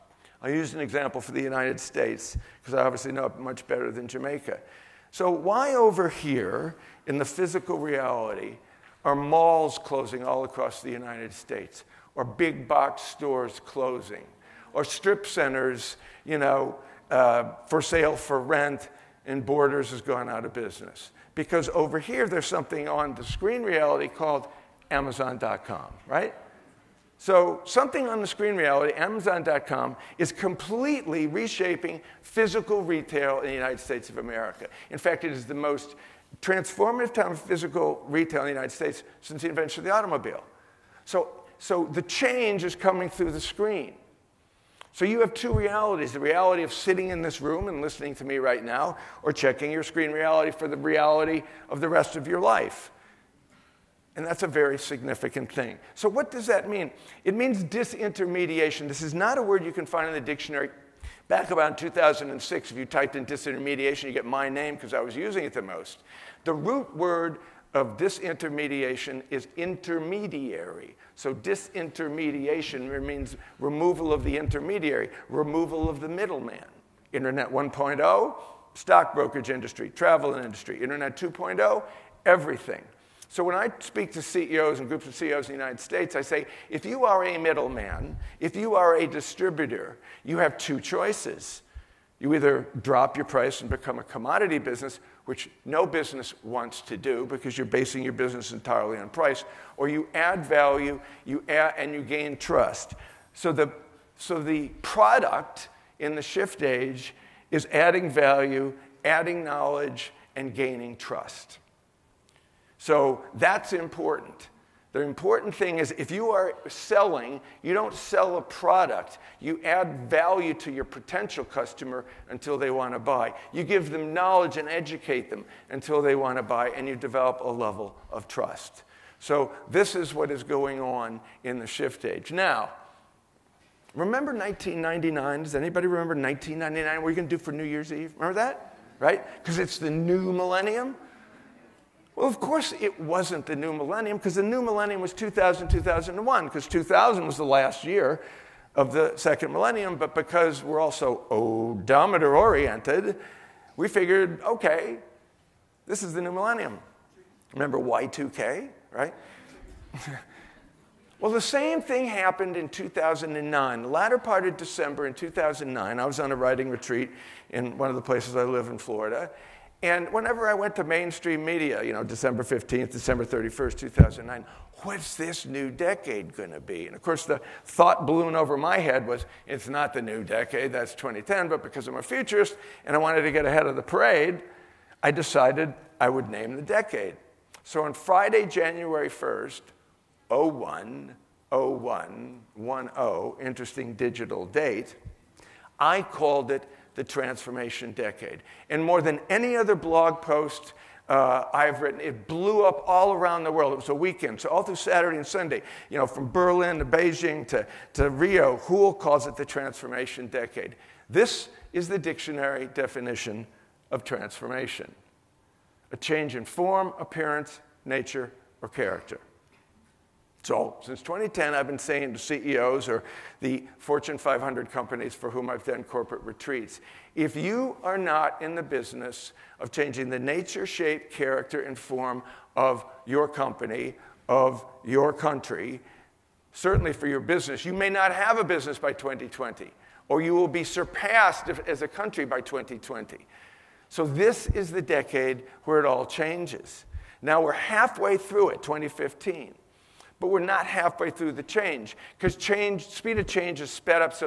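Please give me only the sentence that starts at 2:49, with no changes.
And whenever I went to mainstream media, you know, December 15th, December 31st, 2009, what's this new decade going to be?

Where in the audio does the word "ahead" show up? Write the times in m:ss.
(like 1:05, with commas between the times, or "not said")
3:03.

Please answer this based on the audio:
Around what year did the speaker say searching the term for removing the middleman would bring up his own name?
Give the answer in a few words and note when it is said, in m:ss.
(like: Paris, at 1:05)
2006, at 1:01.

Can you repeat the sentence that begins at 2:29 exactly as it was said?
But because we're also odometer oriented, we figured, okay, this is the new millennium.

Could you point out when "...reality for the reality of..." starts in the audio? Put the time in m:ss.
0:50.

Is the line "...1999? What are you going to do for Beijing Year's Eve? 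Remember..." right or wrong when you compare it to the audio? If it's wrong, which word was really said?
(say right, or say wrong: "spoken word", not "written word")
wrong: "New", not "Beijing".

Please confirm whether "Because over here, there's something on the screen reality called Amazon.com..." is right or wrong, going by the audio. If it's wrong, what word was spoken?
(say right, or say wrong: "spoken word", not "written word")
right.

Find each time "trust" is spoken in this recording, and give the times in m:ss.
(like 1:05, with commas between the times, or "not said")
1:42, 1:50, 2:08.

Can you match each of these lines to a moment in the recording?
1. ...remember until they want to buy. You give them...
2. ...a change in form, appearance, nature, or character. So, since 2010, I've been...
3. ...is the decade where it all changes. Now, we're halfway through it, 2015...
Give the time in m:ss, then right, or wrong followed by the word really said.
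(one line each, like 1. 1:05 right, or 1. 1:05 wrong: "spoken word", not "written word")
1. 2:01 wrong: "customer", not "remember"
2. 3:35 right
3. 4:04 right.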